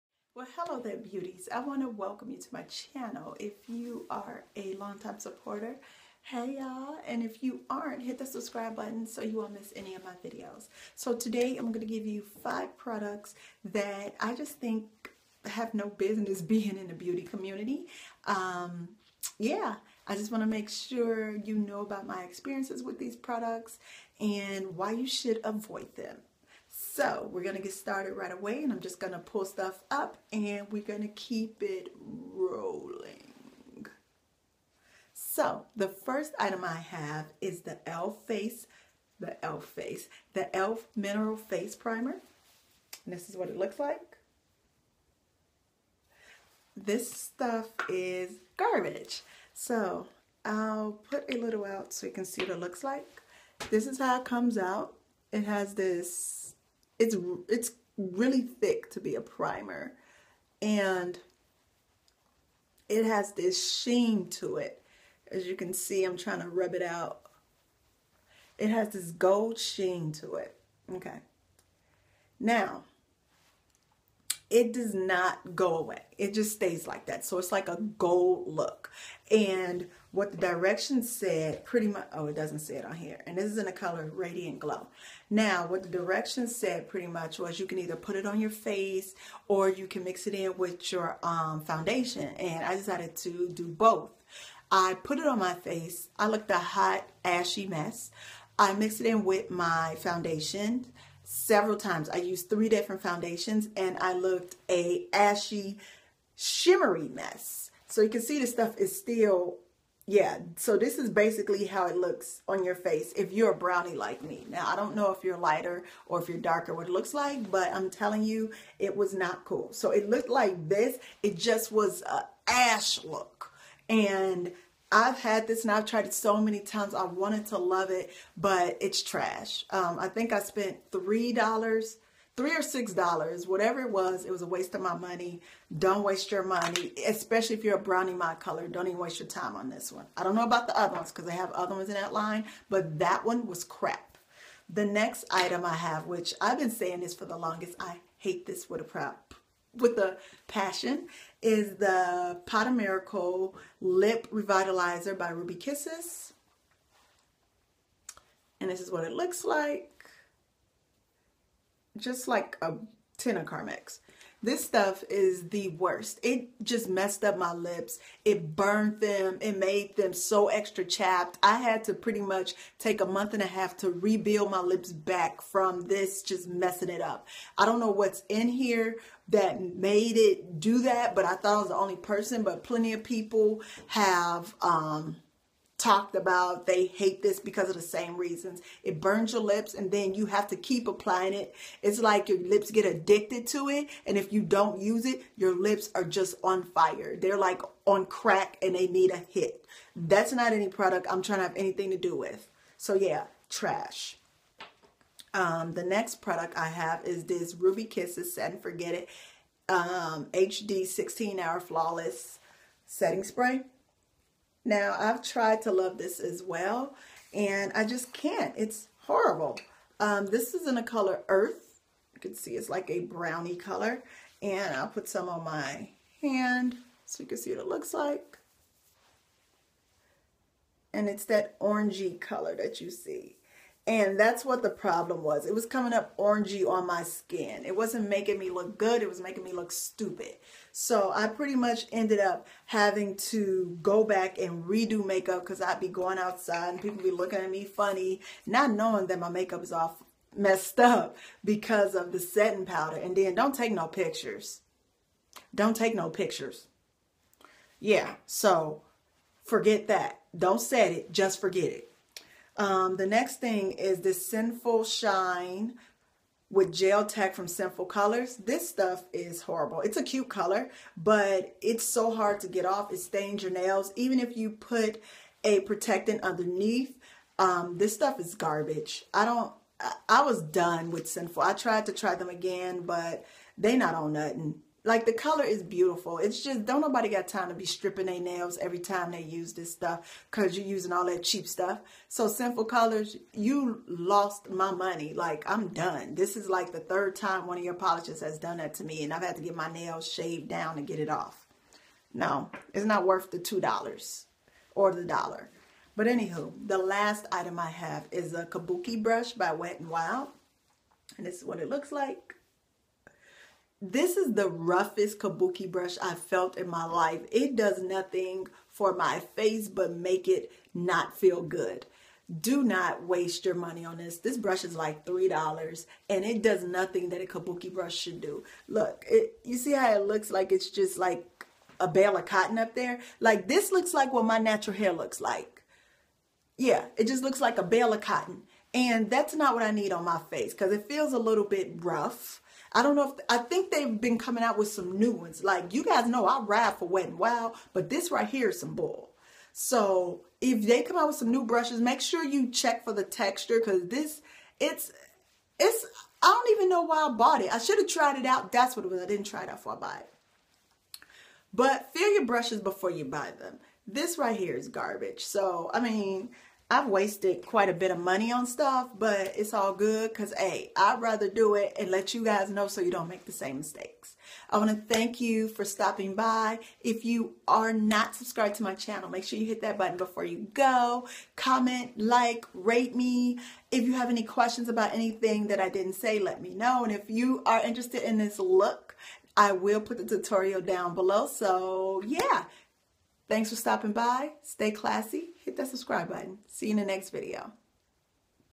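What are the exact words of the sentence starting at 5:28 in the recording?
Look, it, you see how it looks like it's just like a bale of cotton up there?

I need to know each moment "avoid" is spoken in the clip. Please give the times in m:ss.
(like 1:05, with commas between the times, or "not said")
0:25.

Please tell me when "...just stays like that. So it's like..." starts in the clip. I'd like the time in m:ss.
1:16.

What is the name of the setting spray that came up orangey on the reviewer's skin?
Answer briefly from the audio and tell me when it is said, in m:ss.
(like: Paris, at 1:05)
Earth, at 3:41.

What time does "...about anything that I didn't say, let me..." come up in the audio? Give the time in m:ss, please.
6:24.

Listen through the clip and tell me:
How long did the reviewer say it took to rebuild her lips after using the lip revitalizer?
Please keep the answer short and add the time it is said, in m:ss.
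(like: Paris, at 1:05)
a month and a half, at 2:53.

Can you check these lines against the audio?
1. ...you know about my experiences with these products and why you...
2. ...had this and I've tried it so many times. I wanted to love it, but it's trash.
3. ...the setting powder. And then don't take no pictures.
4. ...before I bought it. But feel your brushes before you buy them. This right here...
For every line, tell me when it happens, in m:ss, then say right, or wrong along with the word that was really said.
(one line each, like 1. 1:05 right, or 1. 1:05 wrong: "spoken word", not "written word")
1. 0:21 right
2. 2:05 right
3. 4:12 right
4. 5:59 right.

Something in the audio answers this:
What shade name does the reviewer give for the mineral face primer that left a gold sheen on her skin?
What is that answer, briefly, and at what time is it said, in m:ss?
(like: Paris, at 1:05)
Radiant Glow, at 1:24.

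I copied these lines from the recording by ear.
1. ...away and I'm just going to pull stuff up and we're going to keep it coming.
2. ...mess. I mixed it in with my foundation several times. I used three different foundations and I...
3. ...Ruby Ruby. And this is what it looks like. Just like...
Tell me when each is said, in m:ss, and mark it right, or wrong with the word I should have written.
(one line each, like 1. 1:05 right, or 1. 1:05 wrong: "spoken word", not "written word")
1. 0:28 wrong: "rolling", not "coming"
2. 1:37 right
3. 2:35 wrong: "Kisses", not "Ruby".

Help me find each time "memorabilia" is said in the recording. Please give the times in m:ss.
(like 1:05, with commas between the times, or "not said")
not said.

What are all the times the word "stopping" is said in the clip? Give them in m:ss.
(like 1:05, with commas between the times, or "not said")
6:15, 6:33.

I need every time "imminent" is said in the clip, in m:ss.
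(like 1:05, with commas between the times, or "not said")
not said.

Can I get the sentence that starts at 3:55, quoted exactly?
It was coming up orangey on my skin.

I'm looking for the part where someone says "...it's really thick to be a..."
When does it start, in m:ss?
0:57.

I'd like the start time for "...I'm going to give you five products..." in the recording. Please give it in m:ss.
0:11.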